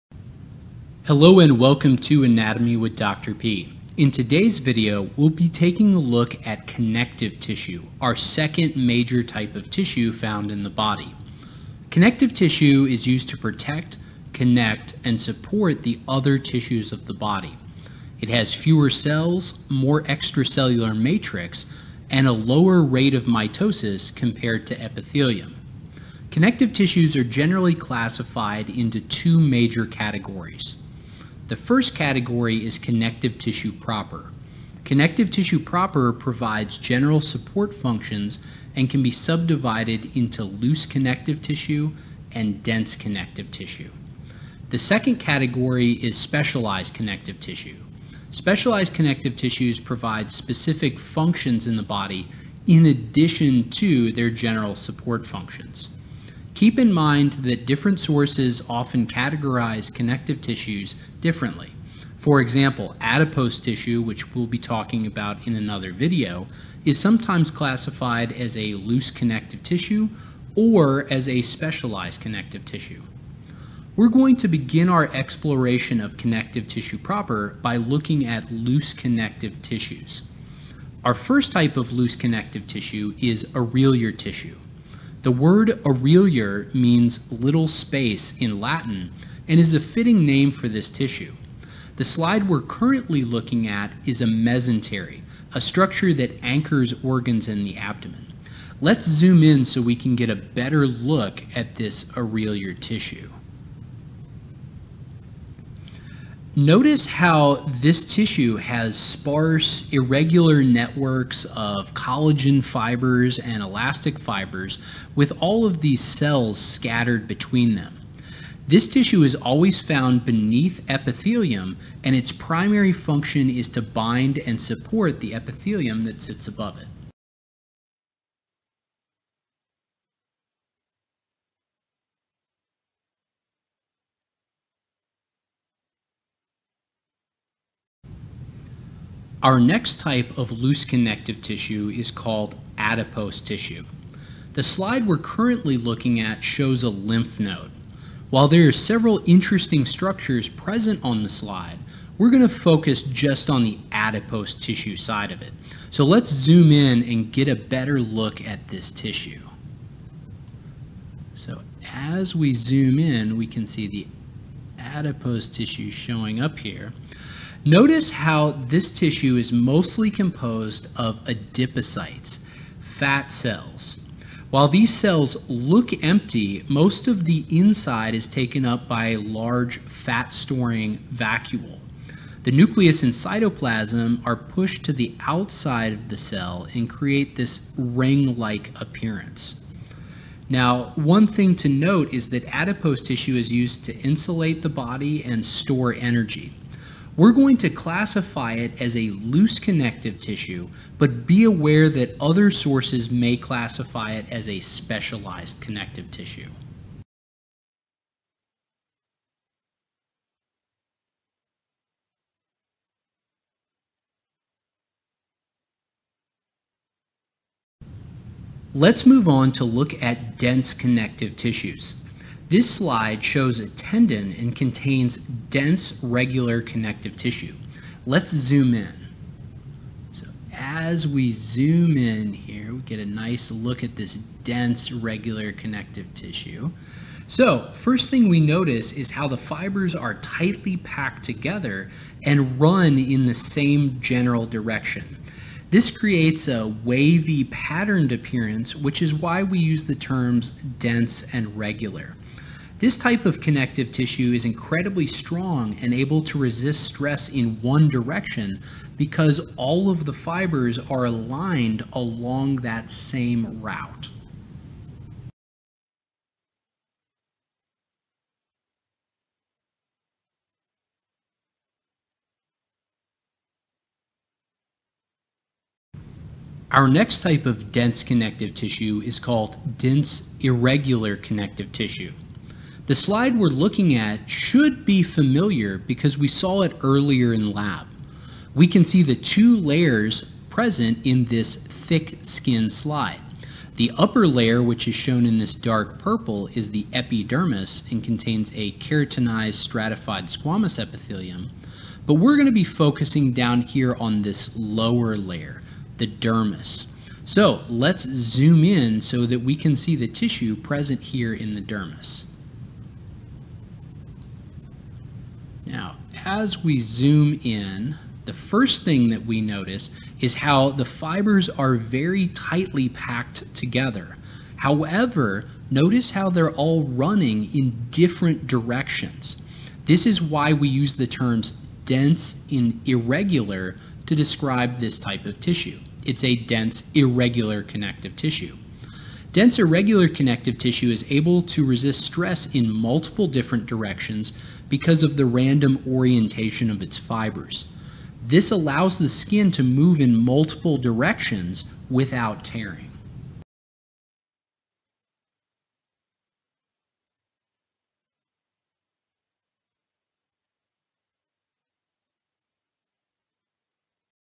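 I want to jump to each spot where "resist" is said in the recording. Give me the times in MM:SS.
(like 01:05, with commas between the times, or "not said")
04:16, 05:41.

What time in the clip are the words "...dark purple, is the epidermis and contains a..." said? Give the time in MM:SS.
04:55.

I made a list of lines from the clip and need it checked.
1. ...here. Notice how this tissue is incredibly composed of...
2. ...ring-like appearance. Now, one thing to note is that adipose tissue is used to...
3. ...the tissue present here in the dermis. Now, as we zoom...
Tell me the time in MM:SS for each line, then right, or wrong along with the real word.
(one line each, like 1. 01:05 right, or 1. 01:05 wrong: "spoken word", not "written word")
1. 02:46 wrong: "mostly", not "incredibly"
2. 03:07 right
3. 05:09 right.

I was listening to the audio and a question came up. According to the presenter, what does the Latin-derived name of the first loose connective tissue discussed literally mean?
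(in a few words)
little space.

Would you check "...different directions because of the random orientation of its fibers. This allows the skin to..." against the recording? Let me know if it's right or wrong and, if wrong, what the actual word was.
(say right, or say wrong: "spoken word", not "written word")
right.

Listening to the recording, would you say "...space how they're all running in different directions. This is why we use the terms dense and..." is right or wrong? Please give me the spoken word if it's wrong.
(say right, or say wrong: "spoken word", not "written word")
wrong: "notice", not "space".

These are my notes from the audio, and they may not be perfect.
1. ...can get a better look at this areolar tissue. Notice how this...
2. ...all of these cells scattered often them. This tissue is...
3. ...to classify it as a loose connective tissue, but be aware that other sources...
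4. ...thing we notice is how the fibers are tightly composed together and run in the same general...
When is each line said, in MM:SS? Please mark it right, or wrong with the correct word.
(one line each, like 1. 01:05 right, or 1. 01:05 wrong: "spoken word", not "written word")
1. 01:39 right
2. 01:55 wrong: "between", not "often"
3. 03:17 right
4. 03:58 wrong: "packed", not "composed".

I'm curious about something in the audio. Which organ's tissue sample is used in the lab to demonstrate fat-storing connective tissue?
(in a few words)
lymph node.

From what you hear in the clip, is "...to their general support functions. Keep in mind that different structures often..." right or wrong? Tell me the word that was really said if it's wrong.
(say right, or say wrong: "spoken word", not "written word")
wrong: "sources", not "structures".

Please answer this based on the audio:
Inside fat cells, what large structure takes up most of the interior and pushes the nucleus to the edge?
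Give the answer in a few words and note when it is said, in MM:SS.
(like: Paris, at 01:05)
fat-storing vacuole, at 02:59.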